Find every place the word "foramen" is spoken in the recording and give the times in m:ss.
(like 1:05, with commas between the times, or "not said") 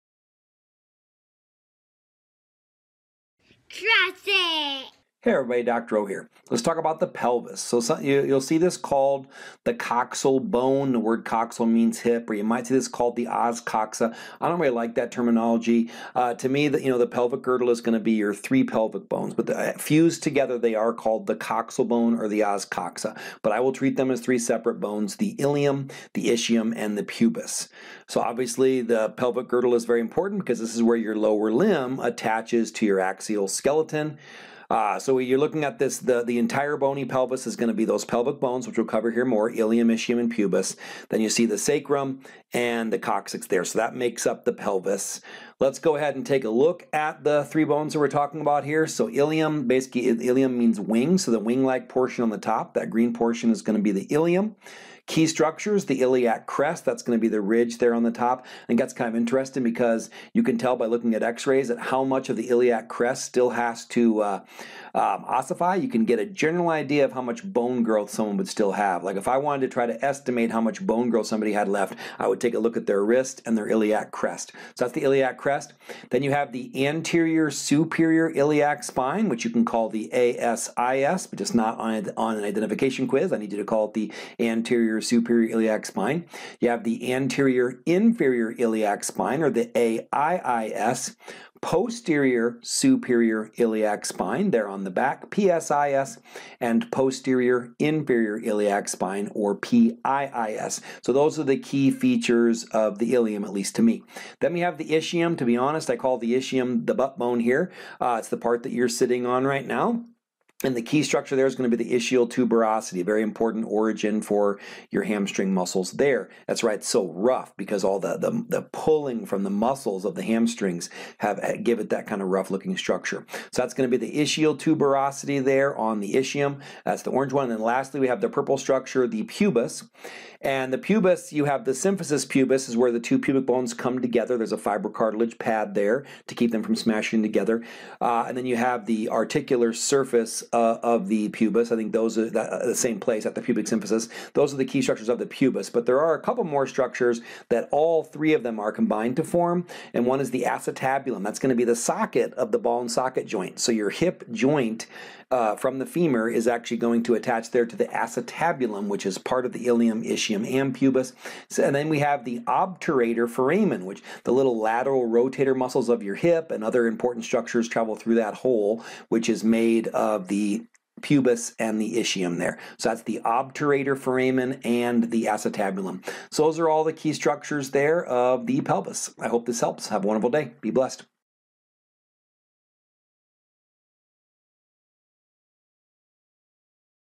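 2:43, 2:53.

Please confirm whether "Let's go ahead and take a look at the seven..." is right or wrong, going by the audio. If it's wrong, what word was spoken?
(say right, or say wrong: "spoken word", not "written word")
wrong: "three", not "seven".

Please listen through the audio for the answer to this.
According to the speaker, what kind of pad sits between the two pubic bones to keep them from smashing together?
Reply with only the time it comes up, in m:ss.
2:14.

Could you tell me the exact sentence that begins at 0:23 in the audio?
But I will treat them as three separate bones: the ilium, the ischium, and the pubis.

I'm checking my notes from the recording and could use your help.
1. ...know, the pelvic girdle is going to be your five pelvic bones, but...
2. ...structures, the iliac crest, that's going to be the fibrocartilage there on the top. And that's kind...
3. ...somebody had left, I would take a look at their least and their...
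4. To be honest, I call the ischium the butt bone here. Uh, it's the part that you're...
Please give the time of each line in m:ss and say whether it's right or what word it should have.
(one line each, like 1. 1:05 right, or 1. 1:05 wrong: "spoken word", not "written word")
1. 0:16 wrong: "three", not "five"
2. 0:55 wrong: "ridge", not "fibrocartilage"
3. 1:11 wrong: "wrist", not "least"
4. 1:45 right.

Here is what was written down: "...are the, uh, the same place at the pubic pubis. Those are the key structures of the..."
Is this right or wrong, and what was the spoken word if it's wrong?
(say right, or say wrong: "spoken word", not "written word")
wrong: "symphysis", not "pubis".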